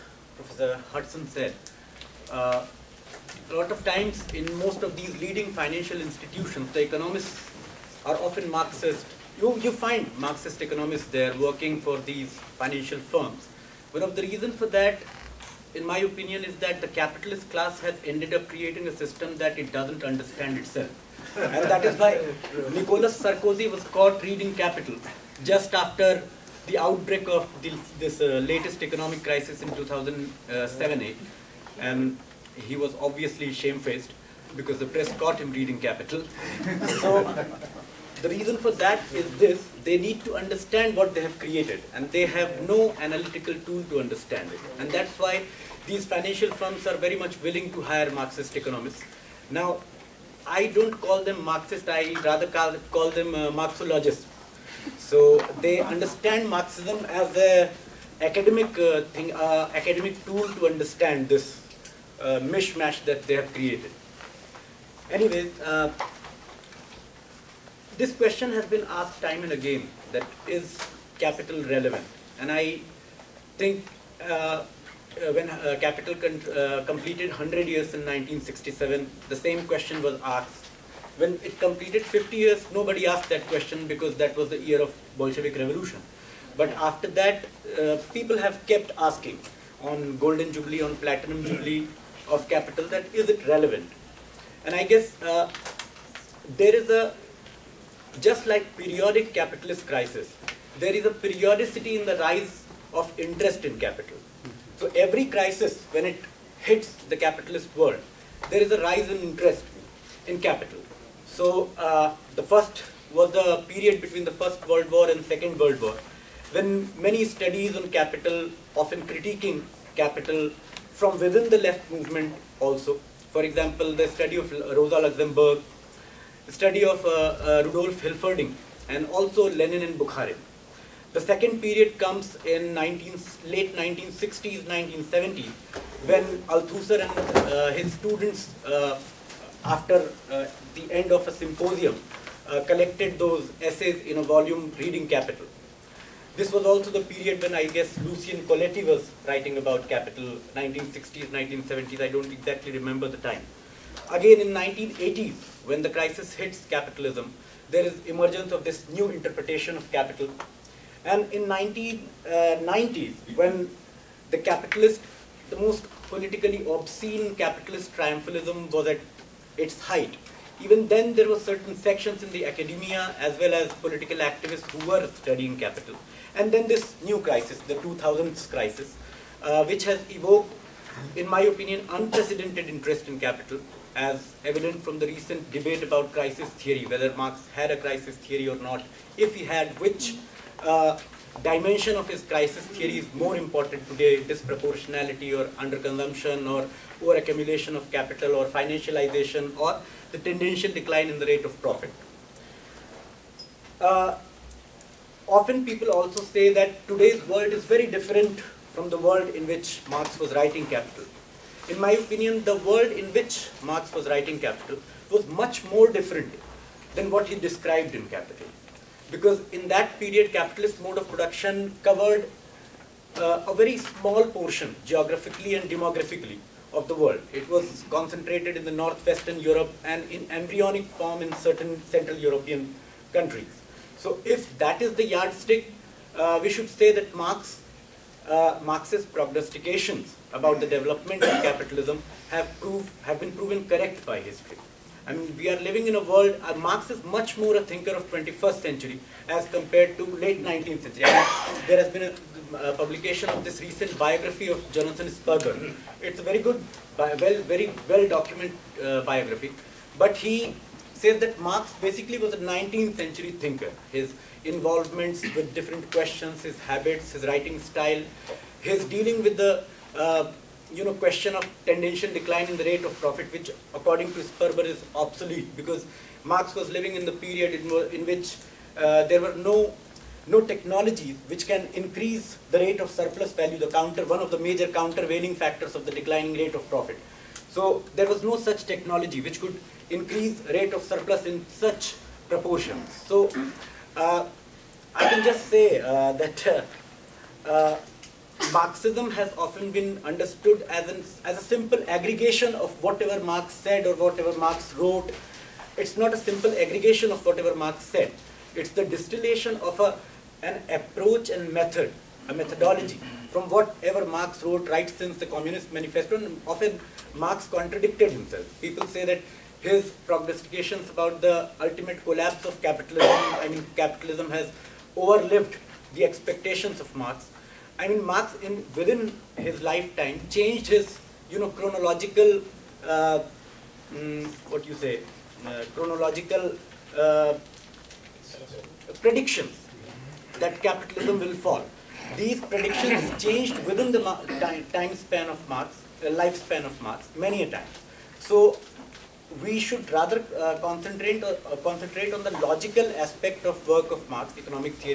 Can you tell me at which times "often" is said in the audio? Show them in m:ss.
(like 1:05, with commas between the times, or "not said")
0:08, 1:58, 3:25, 4:59, 5:16.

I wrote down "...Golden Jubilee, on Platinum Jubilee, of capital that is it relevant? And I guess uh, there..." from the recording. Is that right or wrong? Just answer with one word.
right.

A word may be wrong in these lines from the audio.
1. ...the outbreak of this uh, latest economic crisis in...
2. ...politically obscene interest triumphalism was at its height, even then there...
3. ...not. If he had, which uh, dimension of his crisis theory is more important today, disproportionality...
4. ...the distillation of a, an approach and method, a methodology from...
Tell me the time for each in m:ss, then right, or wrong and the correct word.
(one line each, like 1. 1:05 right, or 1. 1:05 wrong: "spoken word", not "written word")
1. 0:26 right
2. 2:46 wrong: "capitalist", not "interest"
3. 3:08 right
4. 5:08 right.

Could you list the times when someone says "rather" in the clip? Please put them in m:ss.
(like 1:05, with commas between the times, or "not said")
0:52, 5:49.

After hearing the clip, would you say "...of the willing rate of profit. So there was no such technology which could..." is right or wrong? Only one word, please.
wrong.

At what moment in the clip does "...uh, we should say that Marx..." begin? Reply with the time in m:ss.
3:56.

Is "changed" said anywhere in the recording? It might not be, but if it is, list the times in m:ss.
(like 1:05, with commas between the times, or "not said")
5:30, 5:43.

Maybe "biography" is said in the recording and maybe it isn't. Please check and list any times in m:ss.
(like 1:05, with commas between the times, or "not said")
4:13, 4:19.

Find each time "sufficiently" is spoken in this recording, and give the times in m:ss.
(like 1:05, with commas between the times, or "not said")
not said.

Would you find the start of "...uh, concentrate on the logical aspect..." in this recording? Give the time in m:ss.
5:51.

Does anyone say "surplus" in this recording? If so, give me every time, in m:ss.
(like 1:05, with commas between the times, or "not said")
4:42, 4:50.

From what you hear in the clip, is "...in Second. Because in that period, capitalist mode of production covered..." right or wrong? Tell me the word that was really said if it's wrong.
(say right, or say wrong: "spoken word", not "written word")
wrong: "Capital", not "Second".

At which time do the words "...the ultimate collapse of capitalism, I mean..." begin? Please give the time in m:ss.
5:21.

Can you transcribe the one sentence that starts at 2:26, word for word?
This was also the period when I guess Lucio Colletti was writing about capital, 1960s, 1970s, I don't exactly remember the time.